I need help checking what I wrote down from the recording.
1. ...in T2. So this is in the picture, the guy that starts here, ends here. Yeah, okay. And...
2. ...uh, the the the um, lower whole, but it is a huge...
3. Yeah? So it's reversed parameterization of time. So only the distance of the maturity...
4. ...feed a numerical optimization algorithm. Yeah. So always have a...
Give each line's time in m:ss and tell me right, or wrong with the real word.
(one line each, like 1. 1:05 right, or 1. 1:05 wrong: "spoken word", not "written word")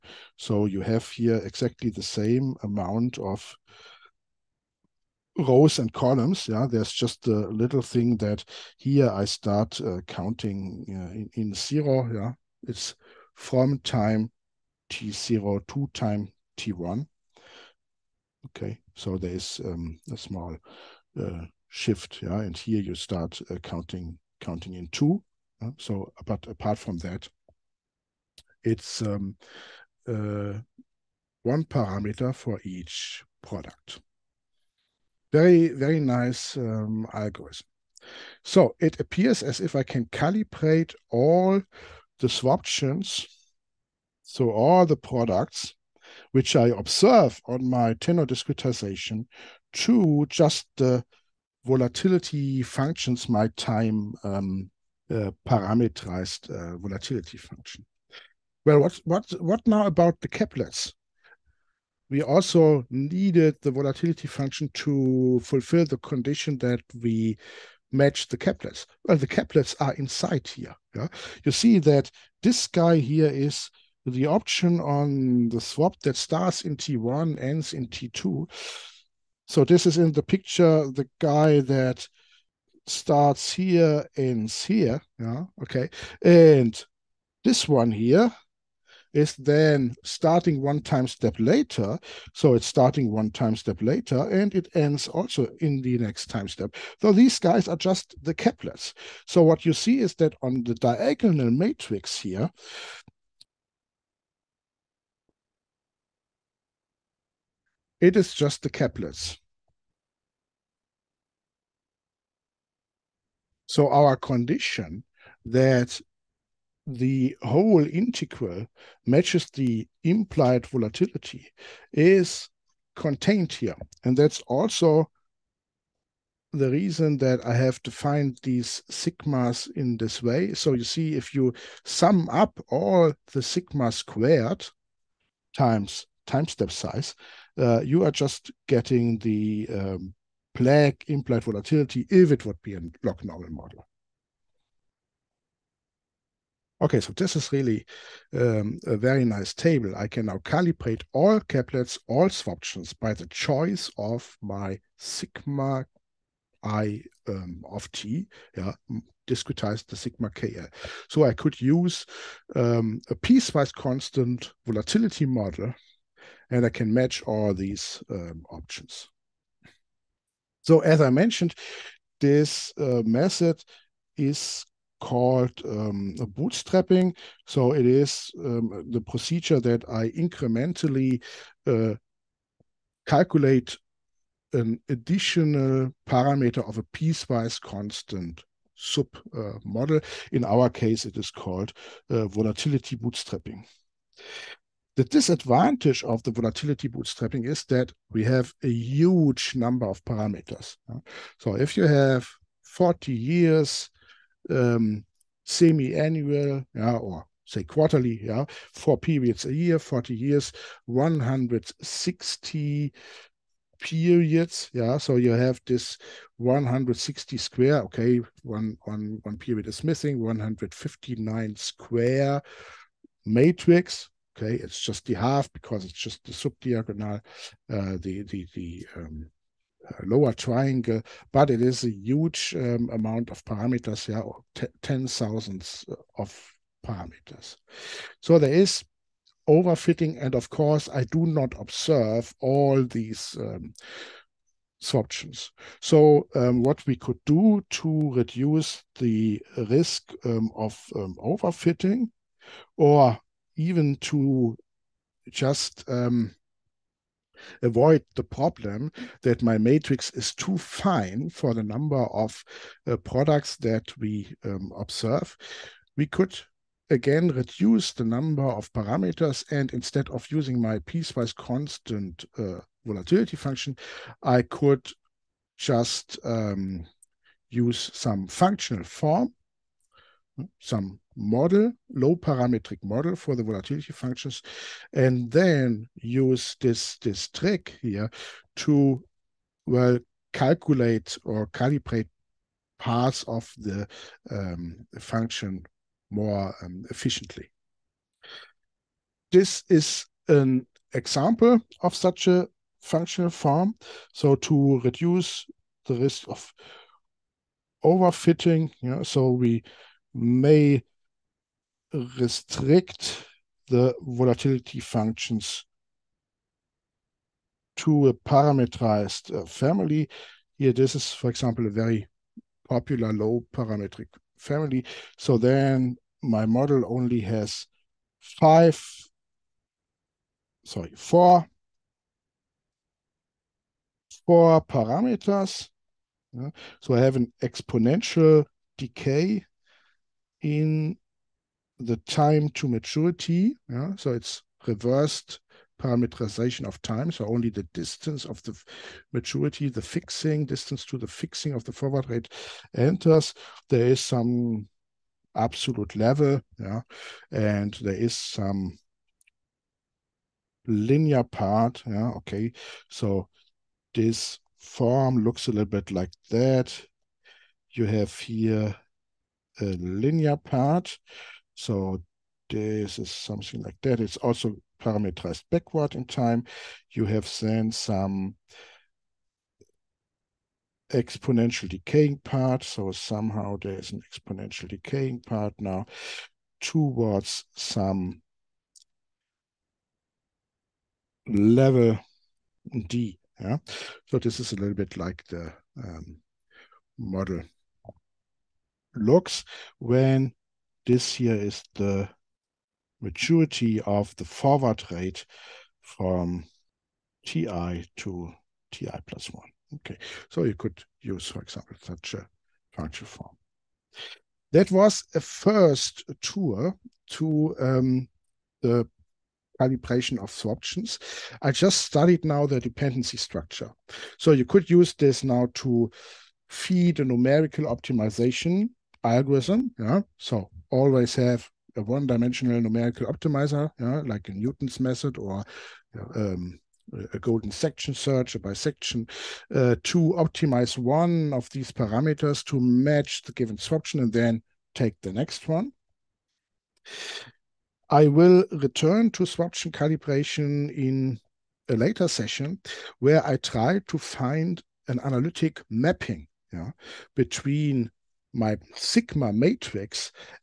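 1. 1:17 right
2. 3:47 wrong: "triangle", not "whole"
3. 5:43 right
4. 7:06 right.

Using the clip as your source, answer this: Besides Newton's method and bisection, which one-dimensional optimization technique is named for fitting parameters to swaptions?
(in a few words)
Golden section search.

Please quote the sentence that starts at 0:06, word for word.
Yeah, there's just a little thing that here I start uh, counting uh, in, in, zero.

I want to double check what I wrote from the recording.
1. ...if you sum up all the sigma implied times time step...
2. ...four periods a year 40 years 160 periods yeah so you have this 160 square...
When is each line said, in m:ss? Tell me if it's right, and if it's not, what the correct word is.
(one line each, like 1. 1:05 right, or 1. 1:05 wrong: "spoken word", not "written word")
1. 2:11 wrong: "squared", not "implied"
2. 3:28 right.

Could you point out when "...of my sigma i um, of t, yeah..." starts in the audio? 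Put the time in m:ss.
2:33.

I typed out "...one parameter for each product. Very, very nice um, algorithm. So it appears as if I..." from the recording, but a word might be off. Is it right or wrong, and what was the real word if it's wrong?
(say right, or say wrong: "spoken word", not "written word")
right.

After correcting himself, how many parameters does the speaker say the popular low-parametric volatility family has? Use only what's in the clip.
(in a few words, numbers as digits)
4.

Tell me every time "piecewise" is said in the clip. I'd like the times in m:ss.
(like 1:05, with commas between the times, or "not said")
2:43, 3:06, 4:30.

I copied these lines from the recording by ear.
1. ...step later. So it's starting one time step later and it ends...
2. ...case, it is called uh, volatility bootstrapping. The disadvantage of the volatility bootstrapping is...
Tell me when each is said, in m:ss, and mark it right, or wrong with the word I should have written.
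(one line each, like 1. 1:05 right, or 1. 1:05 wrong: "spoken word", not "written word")
1. 1:31 right
2. 3:10 right.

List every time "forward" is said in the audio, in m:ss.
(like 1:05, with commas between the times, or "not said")
5:51, 6:44.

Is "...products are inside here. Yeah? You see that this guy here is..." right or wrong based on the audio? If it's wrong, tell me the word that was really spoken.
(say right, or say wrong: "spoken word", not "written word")
wrong: "caplets", not "products".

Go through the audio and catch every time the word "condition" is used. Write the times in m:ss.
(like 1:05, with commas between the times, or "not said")
1:05, 1:54.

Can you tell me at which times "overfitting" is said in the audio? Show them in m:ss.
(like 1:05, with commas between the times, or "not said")
3:59, 4:11, 5:07.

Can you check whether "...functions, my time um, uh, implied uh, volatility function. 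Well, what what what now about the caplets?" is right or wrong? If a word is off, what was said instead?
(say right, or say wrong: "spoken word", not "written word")
wrong: "parameterized", not "implied".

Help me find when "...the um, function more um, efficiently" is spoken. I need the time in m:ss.
4:53.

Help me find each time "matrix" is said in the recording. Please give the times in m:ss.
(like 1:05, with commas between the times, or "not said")
1:41, 3:43, 4:19, 7:39.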